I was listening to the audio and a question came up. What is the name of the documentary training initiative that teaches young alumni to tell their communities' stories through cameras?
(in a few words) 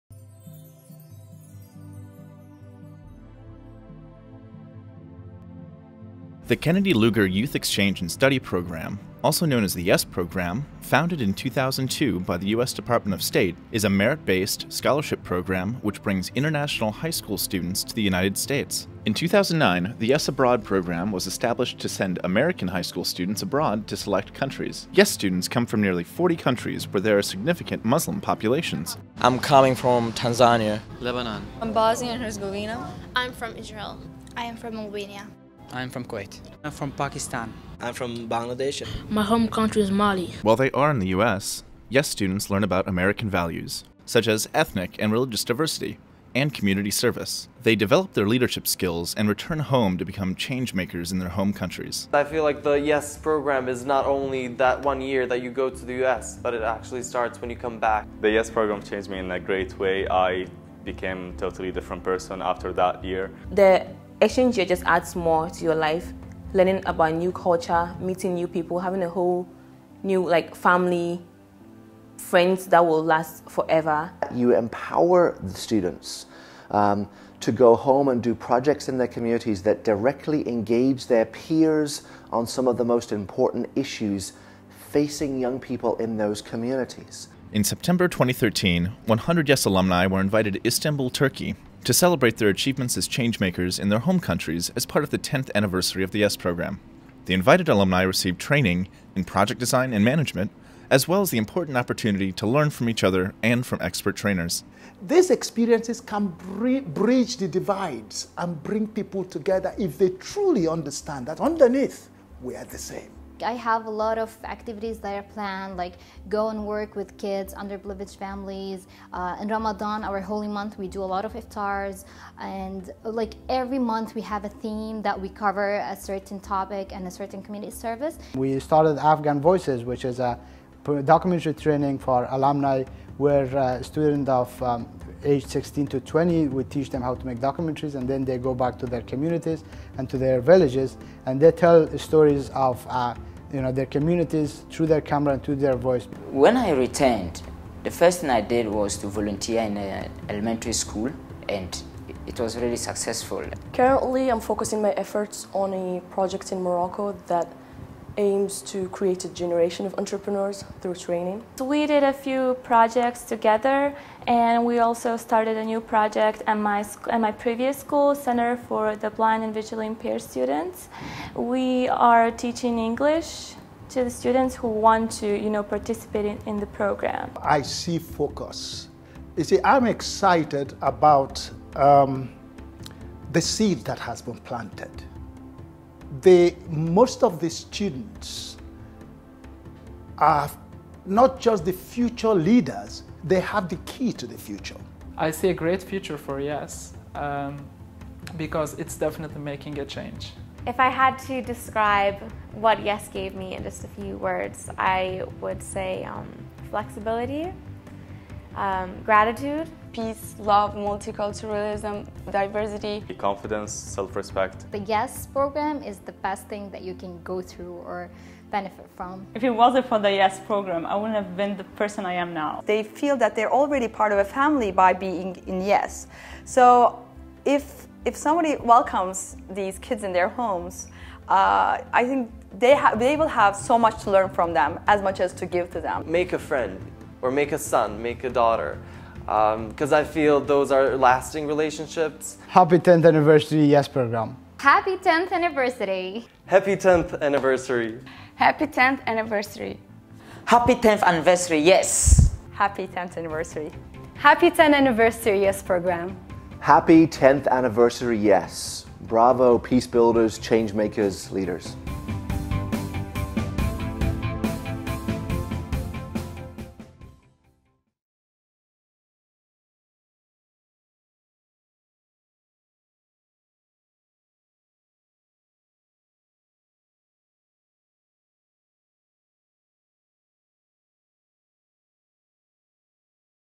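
Afghan Voices.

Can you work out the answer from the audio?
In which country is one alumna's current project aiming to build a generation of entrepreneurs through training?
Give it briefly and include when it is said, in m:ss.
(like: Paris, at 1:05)
Morocco, at 2:36.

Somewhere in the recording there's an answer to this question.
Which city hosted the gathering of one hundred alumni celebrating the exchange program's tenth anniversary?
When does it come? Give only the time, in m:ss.
1:30.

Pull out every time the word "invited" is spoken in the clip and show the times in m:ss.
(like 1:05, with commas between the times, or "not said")
1:30, 1:37.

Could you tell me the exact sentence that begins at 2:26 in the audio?
When I returned, the first thing I did was to volunteer in an elementary school and it was really successful.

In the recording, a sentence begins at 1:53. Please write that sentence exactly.
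I have a lot of activities that are planned, like go and work with kids, underprivileged families.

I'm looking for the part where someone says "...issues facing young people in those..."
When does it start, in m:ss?
1:23.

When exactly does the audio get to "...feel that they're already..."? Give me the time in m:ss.
3:42.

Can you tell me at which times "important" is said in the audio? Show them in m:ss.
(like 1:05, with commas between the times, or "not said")
1:23, 1:41.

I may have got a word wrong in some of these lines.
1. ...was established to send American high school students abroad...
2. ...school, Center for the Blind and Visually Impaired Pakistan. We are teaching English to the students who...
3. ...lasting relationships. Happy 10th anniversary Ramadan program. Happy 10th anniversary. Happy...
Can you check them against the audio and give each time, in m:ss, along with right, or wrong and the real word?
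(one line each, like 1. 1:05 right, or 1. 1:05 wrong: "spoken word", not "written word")
1. 0:21 right
2. 2:47 wrong: "Students", not "Pakistan"
3. 4:00 wrong: "YES", not "Ramadan".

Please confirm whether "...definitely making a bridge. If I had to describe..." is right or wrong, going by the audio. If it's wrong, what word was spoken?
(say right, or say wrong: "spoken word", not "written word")
wrong: "change", not "bridge".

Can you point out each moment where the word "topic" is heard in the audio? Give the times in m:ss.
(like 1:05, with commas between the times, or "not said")
2:06.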